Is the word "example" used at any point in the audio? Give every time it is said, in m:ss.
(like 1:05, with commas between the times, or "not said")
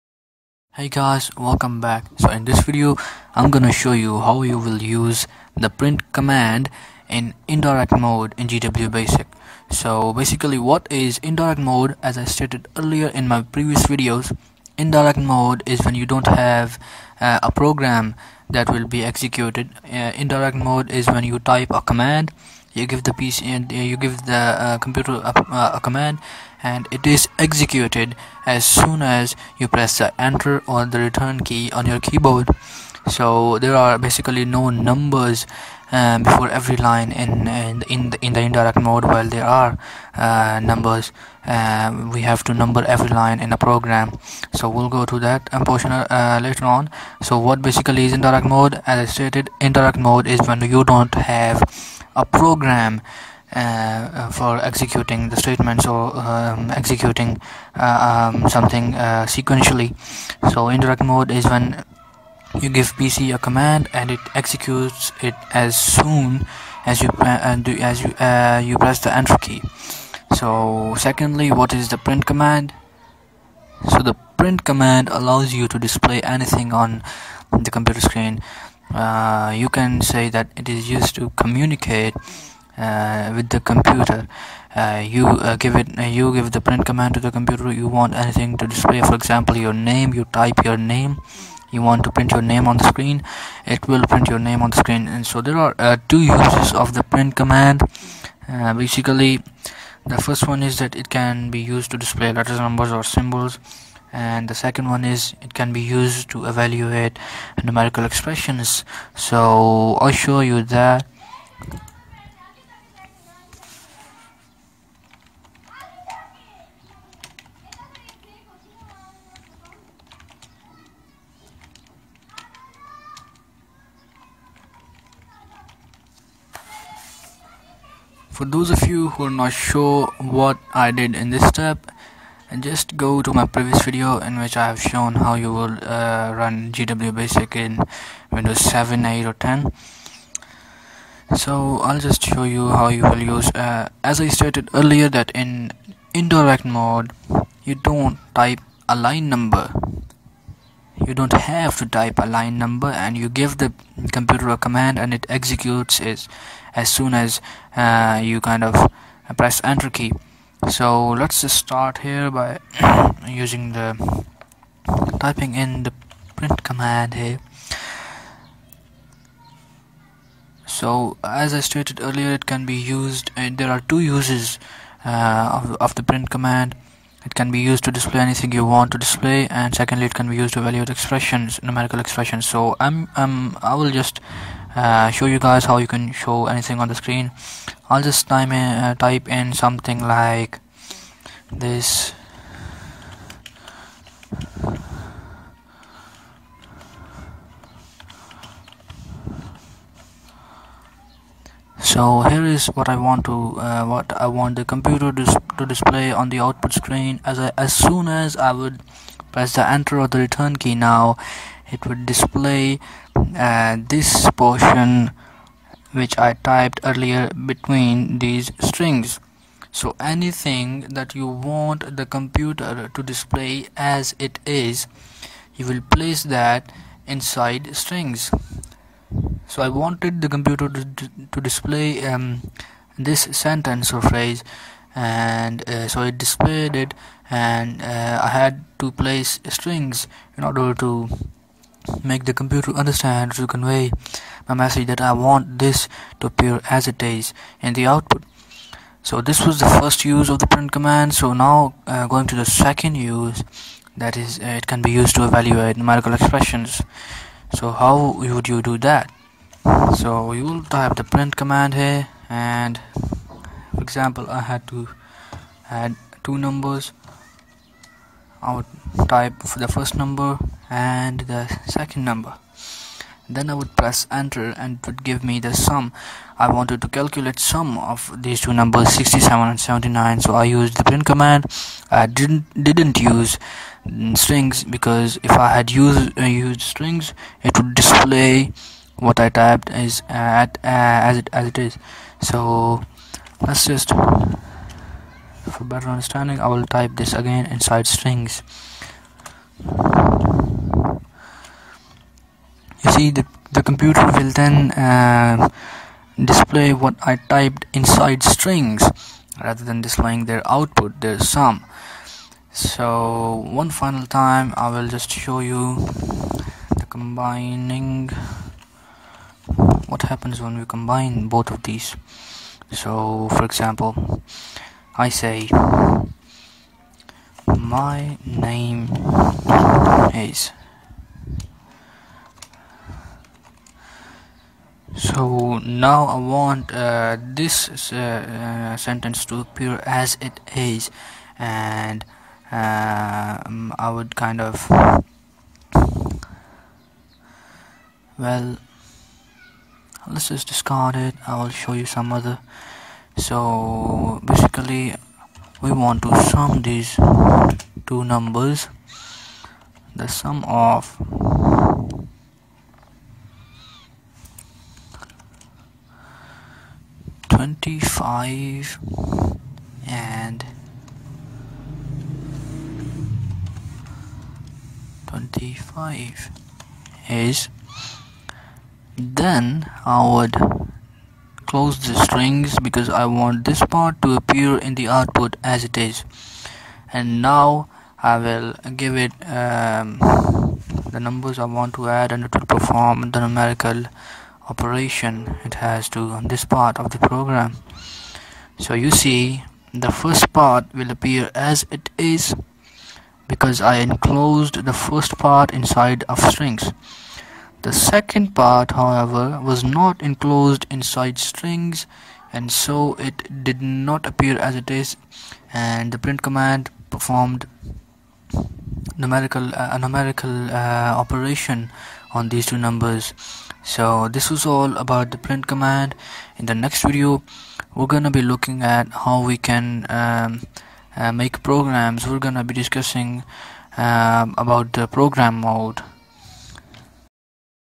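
1:29, 4:23, 5:23.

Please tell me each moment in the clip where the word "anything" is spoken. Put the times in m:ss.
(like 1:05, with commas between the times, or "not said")
1:16, 1:28, 2:58, 3:06, 3:39.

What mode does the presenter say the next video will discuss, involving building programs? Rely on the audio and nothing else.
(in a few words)
program mode.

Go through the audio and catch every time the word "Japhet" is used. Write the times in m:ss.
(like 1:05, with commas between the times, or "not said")
not said.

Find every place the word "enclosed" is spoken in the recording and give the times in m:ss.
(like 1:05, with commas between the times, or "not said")
6:43, 6:50.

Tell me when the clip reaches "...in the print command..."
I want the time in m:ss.
2:45.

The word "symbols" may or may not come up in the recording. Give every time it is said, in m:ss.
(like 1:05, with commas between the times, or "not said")
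1:43.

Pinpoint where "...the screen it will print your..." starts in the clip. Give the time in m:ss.
1:32.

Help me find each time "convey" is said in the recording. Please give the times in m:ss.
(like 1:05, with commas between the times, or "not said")
4:03.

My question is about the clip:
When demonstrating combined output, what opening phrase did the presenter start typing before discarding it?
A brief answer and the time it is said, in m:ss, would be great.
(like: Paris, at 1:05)
my name is, at 5:27.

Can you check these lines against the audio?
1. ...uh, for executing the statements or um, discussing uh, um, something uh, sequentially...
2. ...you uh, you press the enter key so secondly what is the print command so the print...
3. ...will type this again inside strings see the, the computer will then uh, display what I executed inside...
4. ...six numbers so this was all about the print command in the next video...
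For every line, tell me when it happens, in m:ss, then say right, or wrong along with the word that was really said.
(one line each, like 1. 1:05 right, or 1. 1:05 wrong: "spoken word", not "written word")
1. 0:53 wrong: "executing", not "discussing"
2. 1:08 right
3. 4:56 wrong: "typed", not "executed"
4. 7:02 wrong: "two", not "six".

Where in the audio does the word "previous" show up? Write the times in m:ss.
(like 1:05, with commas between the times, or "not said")
0:13, 2:13.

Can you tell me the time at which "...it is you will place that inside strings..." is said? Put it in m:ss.
3:44.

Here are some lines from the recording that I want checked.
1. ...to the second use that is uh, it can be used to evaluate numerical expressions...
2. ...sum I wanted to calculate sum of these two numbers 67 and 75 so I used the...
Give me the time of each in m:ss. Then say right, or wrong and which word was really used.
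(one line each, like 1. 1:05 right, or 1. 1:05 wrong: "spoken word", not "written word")
1. 4:12 right
2. 4:35 wrong: "79", not "75".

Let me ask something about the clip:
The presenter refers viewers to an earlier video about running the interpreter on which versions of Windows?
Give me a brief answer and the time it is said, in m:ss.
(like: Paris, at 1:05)
7, 8 or 10, at 2:18.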